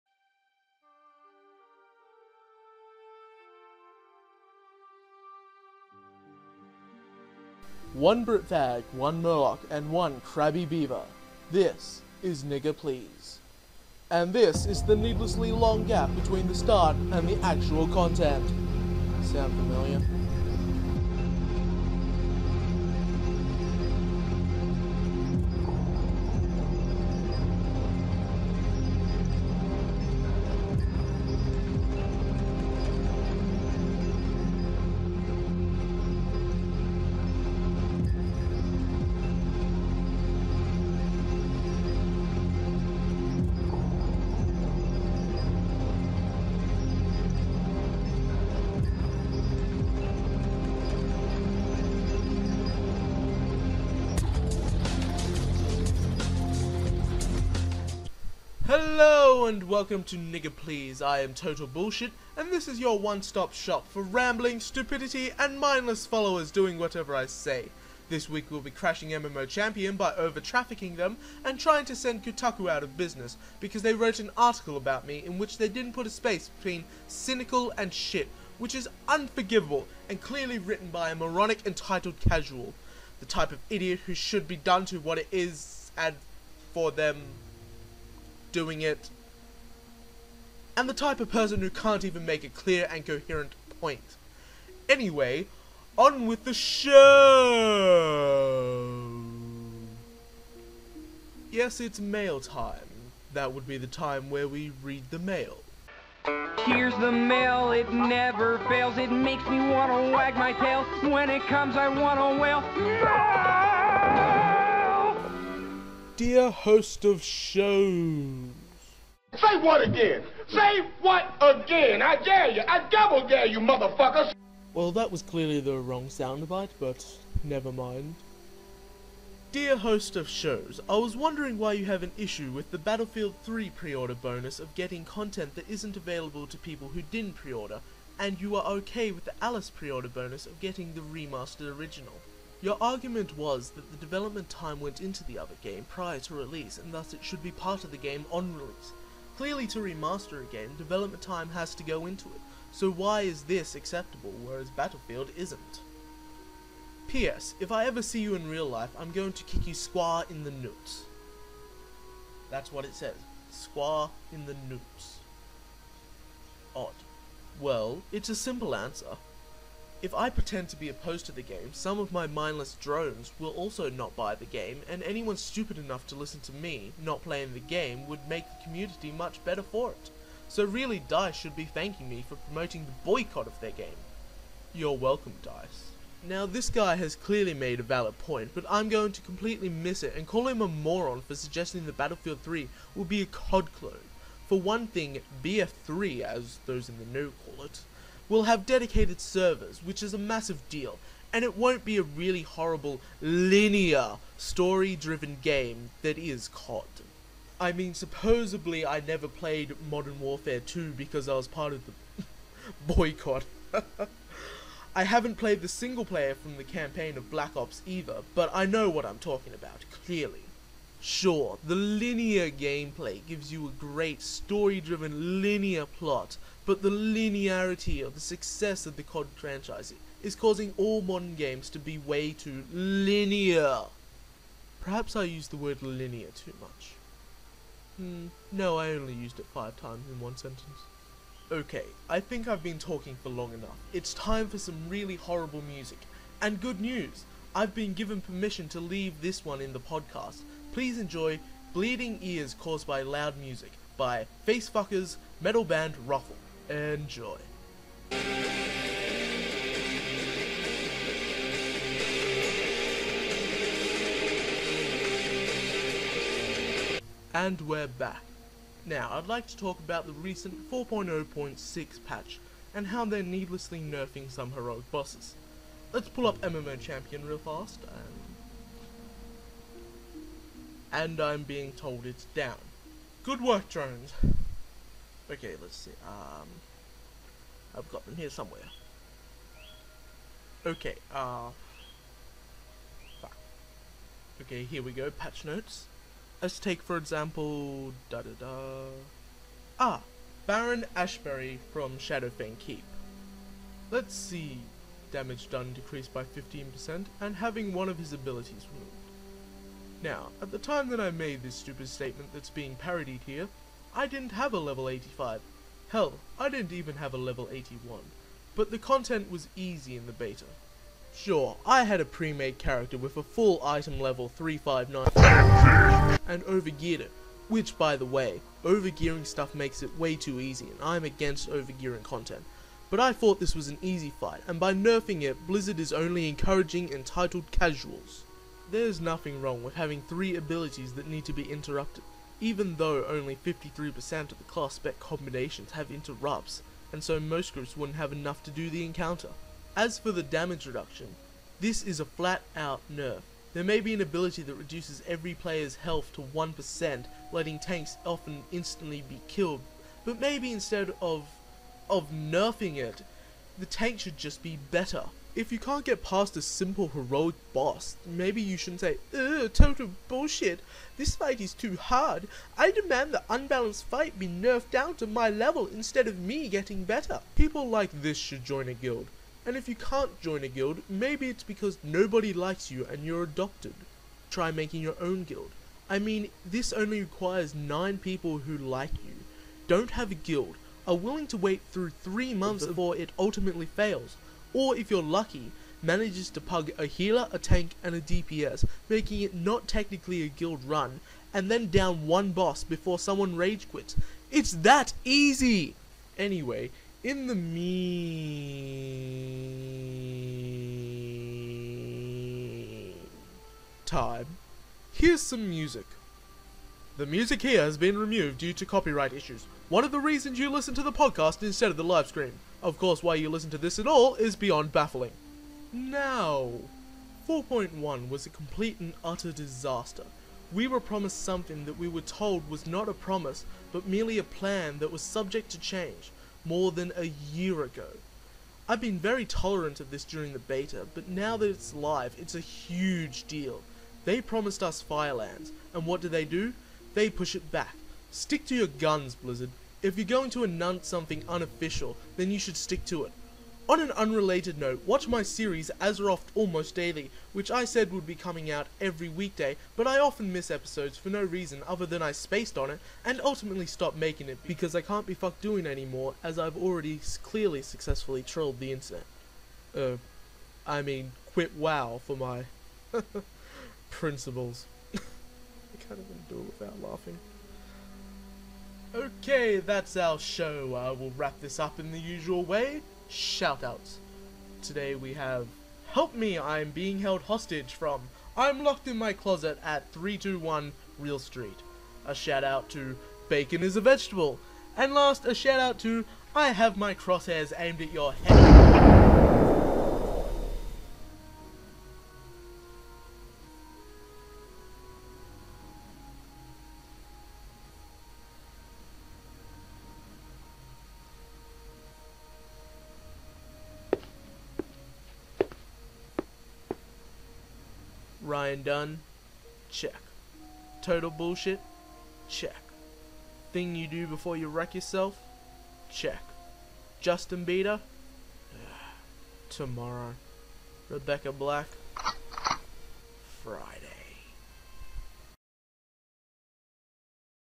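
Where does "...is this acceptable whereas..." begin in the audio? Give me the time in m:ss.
2:33.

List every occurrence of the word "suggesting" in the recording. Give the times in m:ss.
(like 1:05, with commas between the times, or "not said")
3:11.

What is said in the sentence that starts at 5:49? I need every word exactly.
As for the damage reduction, this is a flat out nerf.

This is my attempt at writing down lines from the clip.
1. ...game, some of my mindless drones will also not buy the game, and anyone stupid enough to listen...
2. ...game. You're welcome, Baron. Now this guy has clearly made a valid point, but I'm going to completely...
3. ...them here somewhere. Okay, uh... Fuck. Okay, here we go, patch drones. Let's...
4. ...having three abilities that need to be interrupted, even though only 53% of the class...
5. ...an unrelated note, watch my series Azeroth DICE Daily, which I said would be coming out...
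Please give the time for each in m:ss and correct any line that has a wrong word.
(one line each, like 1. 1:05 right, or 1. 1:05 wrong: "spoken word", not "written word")
1. 2:51 right
2. 3:03 wrong: "DICE", not "Baron"
3. 4:48 wrong: "notes", not "drones"
4. 5:39 right
5. 7:33 wrong: "Almost", not "DICE".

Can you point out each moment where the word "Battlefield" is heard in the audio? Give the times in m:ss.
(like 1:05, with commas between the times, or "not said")
2:12, 2:34, 3:11.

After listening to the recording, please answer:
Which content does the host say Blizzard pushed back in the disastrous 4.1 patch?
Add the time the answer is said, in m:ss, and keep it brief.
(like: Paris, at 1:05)
Firelands, at 7:24.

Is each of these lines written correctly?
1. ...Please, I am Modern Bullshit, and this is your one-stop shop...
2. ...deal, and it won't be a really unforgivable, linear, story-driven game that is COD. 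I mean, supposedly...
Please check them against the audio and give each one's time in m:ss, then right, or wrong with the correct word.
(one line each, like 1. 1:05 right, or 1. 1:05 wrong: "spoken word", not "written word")
1. 1:00 wrong: "Total", not "Modern"
2. 3:20 wrong: "horrible", not "unforgivable".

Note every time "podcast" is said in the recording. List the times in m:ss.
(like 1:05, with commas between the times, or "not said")
4:09, 7:00.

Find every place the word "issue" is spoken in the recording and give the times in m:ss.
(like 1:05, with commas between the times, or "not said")
2:12, 6:59.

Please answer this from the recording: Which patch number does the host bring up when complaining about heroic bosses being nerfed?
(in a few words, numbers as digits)
4.0.6.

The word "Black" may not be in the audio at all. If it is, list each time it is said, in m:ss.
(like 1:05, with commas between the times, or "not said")
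3:37, 8:51.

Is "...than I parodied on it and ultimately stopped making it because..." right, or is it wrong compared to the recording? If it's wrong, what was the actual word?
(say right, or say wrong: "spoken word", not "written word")
wrong: "spaced", not "parodied".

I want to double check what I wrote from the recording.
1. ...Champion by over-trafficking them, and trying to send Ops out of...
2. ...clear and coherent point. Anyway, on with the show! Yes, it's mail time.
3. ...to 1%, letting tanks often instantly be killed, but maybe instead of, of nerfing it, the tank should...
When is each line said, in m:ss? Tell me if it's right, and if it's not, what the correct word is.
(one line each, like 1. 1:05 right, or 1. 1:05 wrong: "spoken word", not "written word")
1. 1:09 wrong: "Kotaku", not "Ops"
2. 1:32 right
3. 5:56 right.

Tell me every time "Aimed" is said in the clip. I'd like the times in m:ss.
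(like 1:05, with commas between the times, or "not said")
8:17.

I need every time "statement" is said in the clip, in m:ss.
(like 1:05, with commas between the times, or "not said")
5:11.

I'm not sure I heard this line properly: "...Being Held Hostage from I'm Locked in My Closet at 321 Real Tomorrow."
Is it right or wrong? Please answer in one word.
wrong.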